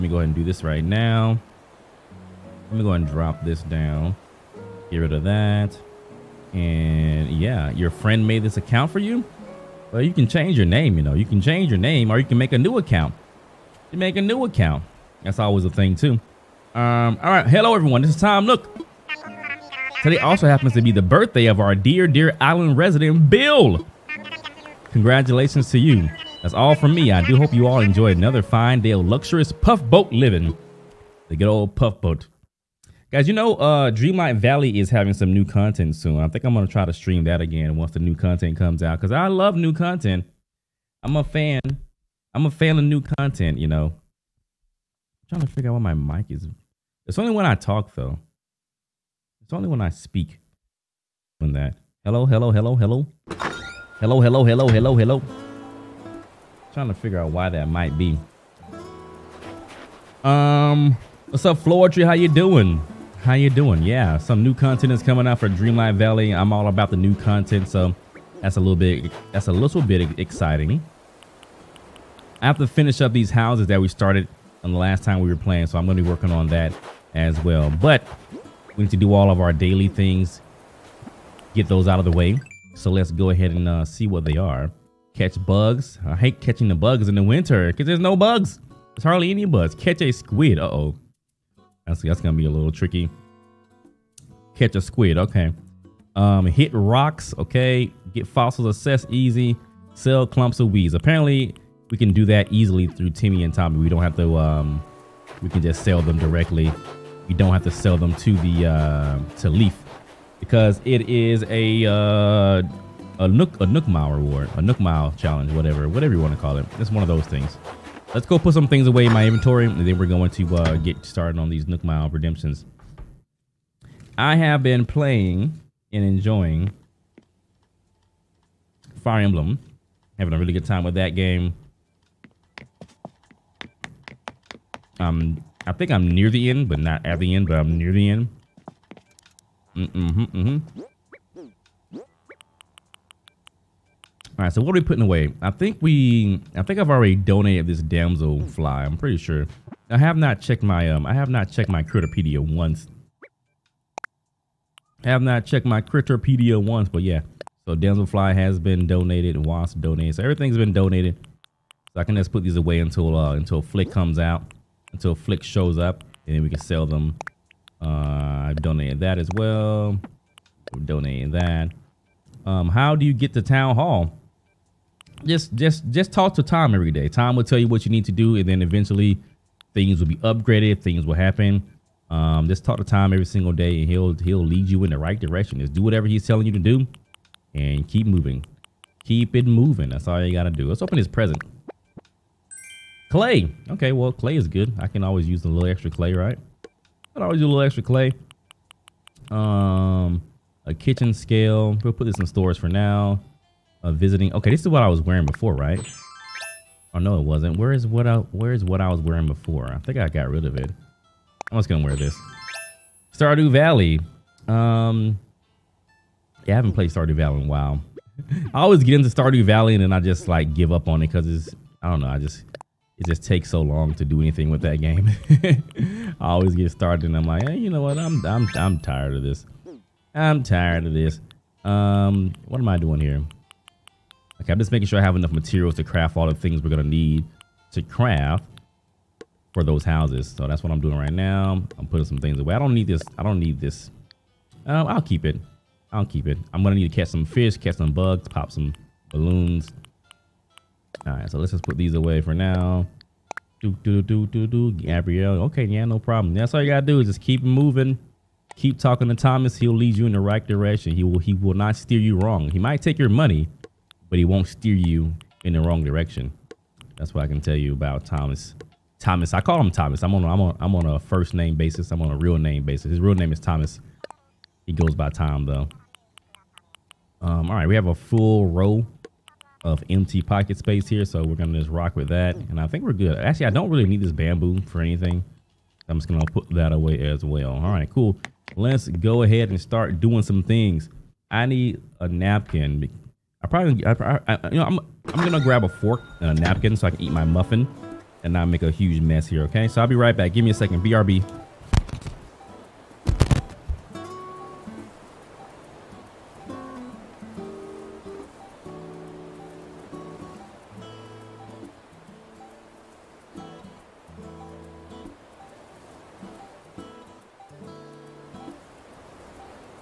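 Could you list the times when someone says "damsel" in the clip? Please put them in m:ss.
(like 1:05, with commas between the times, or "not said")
2:27, 2:37.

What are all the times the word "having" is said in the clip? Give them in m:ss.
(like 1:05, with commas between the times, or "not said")
0:34, 2:10.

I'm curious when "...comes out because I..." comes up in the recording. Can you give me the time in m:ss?
0:38.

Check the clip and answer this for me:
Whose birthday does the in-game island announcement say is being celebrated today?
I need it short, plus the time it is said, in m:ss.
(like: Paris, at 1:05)
Bill, at 0:23.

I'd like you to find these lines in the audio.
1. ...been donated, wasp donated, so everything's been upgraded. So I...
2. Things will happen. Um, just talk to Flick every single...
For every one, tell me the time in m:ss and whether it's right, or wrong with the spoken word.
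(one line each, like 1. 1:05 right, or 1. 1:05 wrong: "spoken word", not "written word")
1. 2:38 wrong: "donated", not "upgraded"
2. 3:00 wrong: "Tom", not "Flick".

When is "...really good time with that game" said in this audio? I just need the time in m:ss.
2:10.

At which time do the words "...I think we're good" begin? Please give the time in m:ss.
4:42.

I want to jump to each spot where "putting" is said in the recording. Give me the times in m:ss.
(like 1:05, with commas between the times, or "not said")
2:24, 4:01.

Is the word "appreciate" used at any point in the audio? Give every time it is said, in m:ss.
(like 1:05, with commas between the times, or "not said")
not said.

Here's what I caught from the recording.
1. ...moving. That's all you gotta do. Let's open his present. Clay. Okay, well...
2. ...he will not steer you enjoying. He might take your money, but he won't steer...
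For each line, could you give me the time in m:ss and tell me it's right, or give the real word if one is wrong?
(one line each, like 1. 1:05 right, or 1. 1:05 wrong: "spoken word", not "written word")
1. 3:09 right
2. 4:21 wrong: "wrong", not "enjoying".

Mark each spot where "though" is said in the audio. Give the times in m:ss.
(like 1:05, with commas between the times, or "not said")
0:47, 4:35.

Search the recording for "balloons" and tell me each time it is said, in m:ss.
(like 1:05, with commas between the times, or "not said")
4:09.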